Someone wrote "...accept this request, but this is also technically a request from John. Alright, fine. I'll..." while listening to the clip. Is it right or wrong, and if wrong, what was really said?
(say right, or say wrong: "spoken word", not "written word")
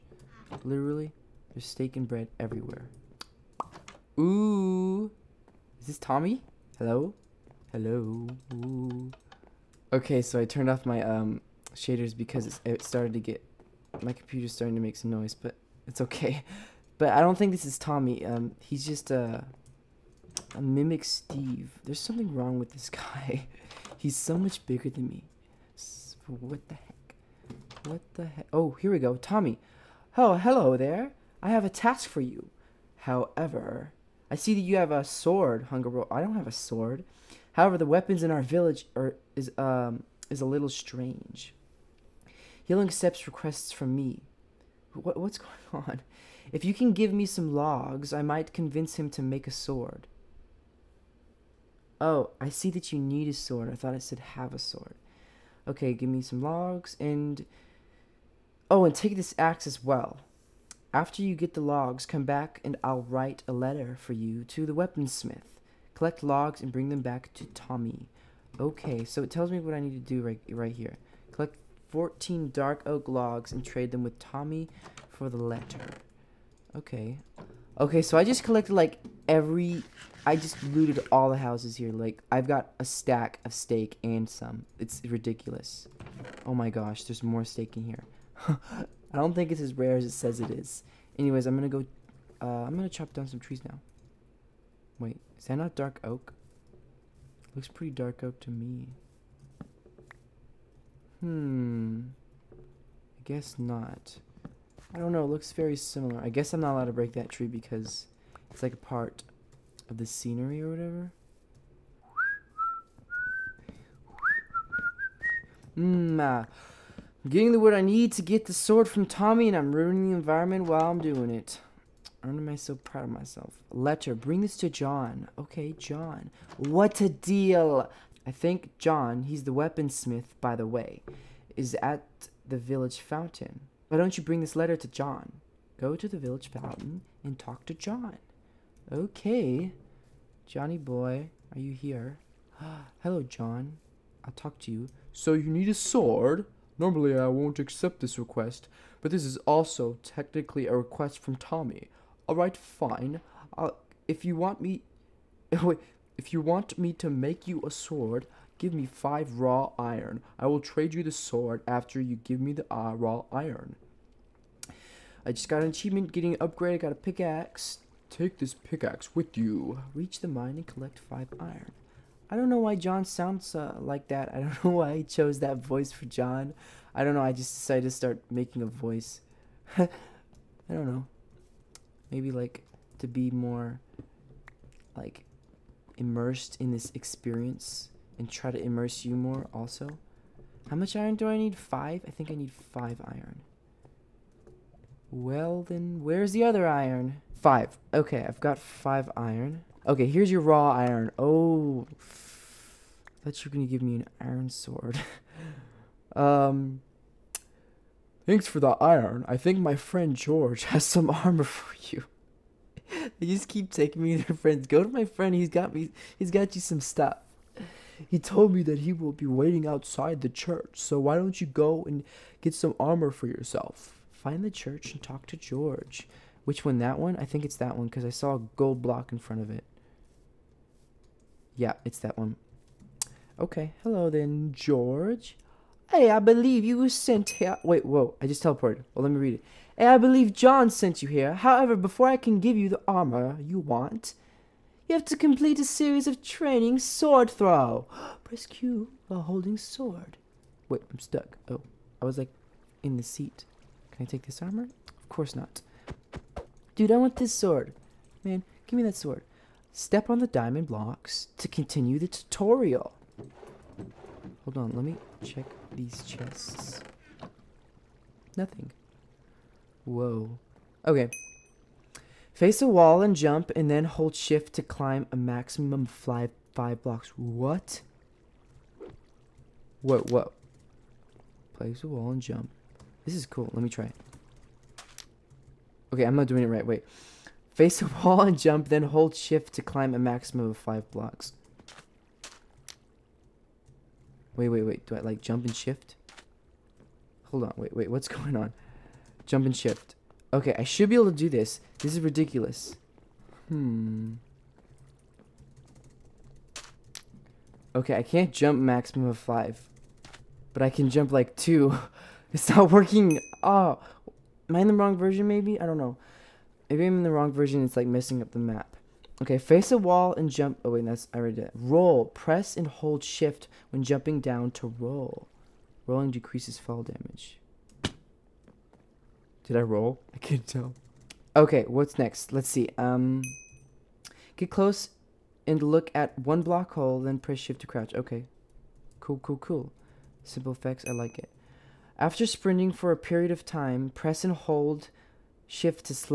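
wrong: "Tommy", not "John".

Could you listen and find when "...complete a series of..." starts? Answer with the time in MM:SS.
04:05.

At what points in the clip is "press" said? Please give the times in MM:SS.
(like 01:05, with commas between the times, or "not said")
04:08, 05:22, 05:37, 05:43.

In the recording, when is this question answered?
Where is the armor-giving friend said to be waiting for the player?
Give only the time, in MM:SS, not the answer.
03:39.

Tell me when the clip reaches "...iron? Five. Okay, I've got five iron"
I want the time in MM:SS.
03:16.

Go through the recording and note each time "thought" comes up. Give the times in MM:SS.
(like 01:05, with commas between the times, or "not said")
00:53, 03:23.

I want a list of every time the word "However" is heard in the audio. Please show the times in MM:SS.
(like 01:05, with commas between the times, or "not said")
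00:32, 00:37, 04:01.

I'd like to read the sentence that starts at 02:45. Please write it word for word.
I just got an achievement, getting an upgrade, I got a pickaxe.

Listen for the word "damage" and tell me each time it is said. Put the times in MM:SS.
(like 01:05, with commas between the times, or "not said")
05:26.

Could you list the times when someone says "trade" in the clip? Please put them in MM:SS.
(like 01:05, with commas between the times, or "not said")
01:13, 02:40.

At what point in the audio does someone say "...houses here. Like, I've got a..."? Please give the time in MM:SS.
01:21.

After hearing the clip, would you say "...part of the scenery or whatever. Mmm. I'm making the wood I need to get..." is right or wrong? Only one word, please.
wrong.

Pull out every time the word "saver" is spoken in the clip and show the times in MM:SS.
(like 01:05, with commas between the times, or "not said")
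not said.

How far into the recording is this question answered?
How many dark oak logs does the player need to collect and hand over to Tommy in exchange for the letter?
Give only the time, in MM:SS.
01:11.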